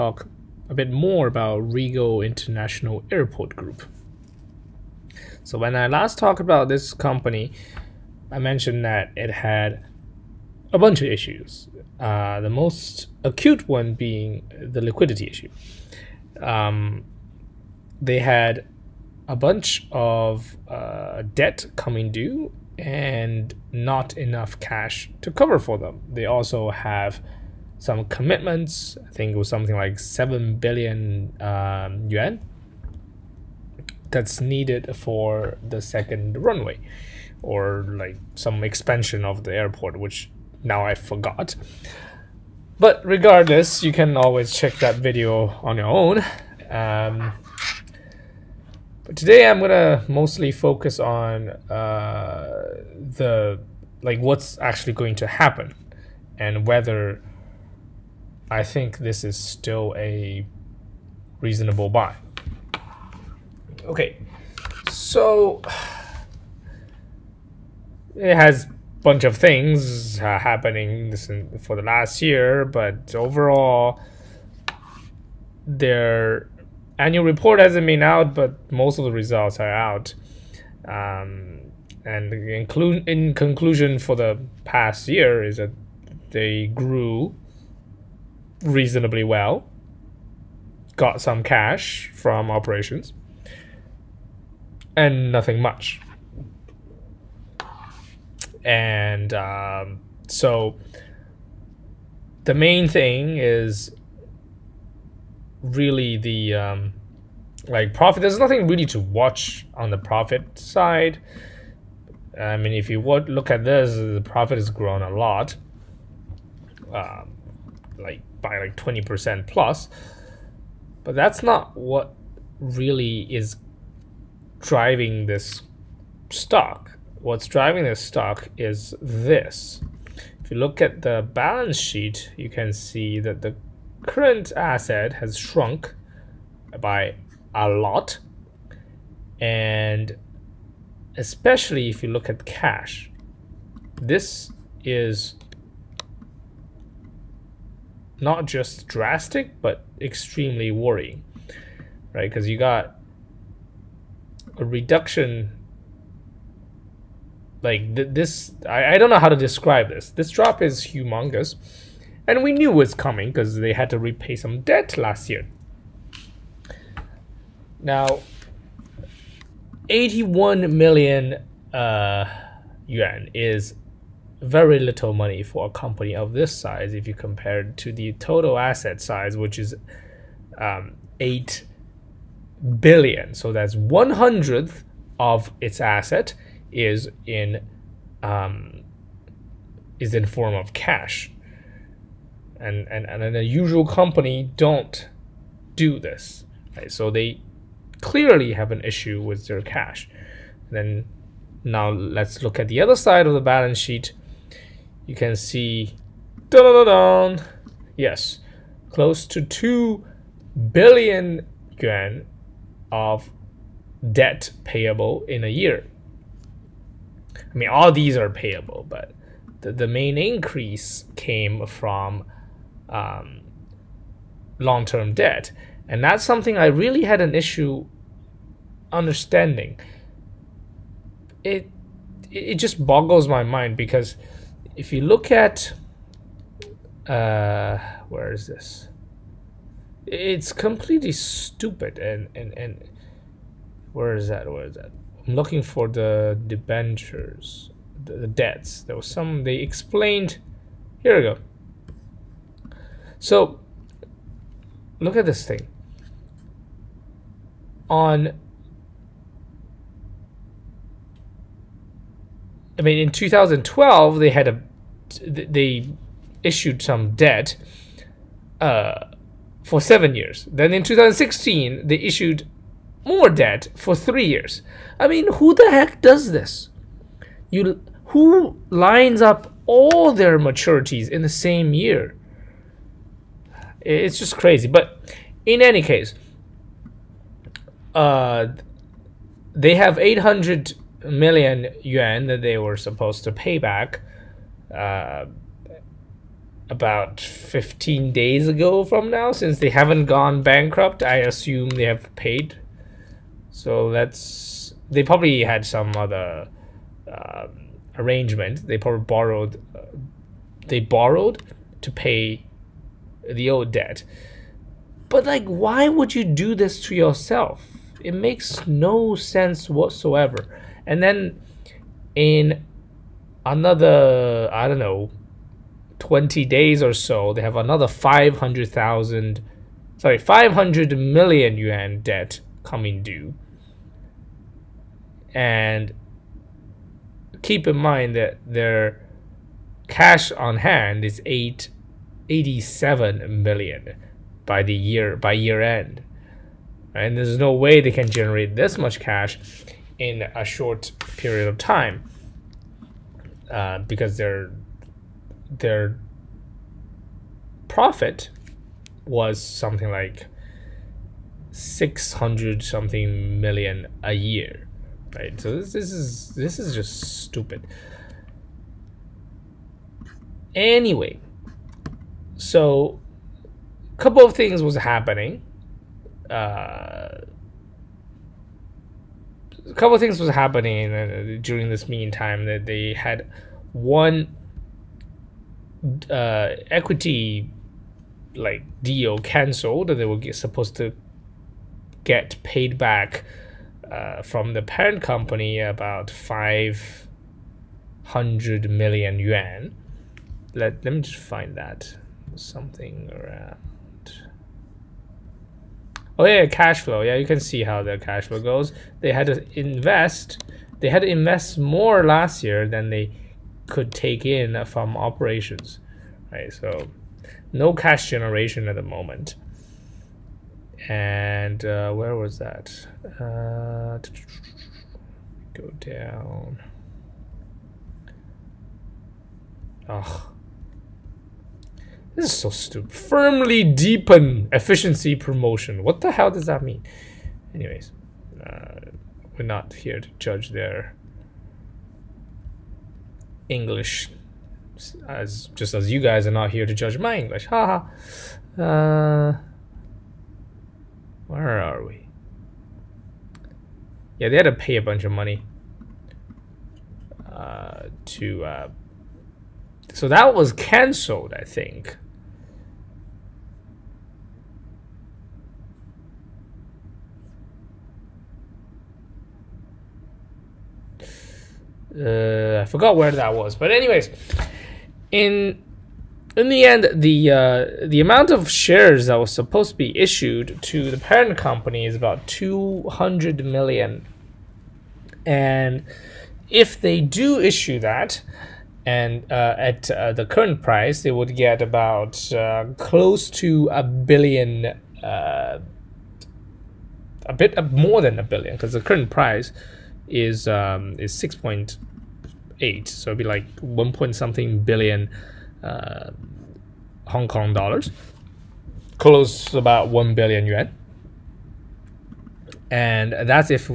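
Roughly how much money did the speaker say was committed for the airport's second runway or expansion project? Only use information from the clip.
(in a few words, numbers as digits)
7 billion yuan.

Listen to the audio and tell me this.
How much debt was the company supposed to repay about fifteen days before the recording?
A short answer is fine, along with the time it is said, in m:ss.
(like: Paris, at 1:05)
800 million yuan, at 4:49.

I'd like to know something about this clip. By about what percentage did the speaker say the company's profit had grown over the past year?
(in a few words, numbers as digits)
20 percent plus.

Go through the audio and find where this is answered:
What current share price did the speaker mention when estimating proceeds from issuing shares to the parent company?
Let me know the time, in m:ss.
8:21.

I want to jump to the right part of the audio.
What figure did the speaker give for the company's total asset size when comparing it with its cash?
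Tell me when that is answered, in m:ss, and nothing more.
3:01.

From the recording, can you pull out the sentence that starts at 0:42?
But regardless, you can always check that video on your own.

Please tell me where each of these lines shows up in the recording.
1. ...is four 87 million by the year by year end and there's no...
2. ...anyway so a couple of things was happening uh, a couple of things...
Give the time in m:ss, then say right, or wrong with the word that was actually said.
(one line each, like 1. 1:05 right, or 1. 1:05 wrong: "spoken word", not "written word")
1. 5:41 wrong: "eight", not "four"
2. 6:10 right.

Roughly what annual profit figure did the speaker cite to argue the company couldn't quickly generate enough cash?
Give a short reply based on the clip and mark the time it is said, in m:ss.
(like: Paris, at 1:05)
600 something million, at 6:01.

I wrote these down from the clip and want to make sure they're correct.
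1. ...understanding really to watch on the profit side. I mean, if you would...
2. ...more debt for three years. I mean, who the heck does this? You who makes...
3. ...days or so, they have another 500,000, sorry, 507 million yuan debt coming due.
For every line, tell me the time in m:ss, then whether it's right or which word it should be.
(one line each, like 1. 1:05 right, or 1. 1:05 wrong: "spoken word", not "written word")
1. 1:48 wrong: "nothing", not "understanding"
2. 4:33 wrong: "lines", not "makes"
3. 5:26 wrong: "500", not "507".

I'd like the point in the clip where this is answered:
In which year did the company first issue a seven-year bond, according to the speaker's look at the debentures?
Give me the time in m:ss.
4:23.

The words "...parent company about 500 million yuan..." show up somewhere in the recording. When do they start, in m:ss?
6:34.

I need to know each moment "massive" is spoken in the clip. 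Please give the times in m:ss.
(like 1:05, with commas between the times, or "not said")
not said.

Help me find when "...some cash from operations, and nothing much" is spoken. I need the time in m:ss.
1:31.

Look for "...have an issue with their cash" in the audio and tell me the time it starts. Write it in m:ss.
3:18.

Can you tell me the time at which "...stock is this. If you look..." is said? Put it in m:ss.
2:07.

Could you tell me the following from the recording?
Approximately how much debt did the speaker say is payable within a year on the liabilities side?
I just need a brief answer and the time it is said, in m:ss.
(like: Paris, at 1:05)
close to 2 billion yuan, at 3:28.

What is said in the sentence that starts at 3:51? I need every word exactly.
It, it just boggles my mind because if you look at uh, where is this?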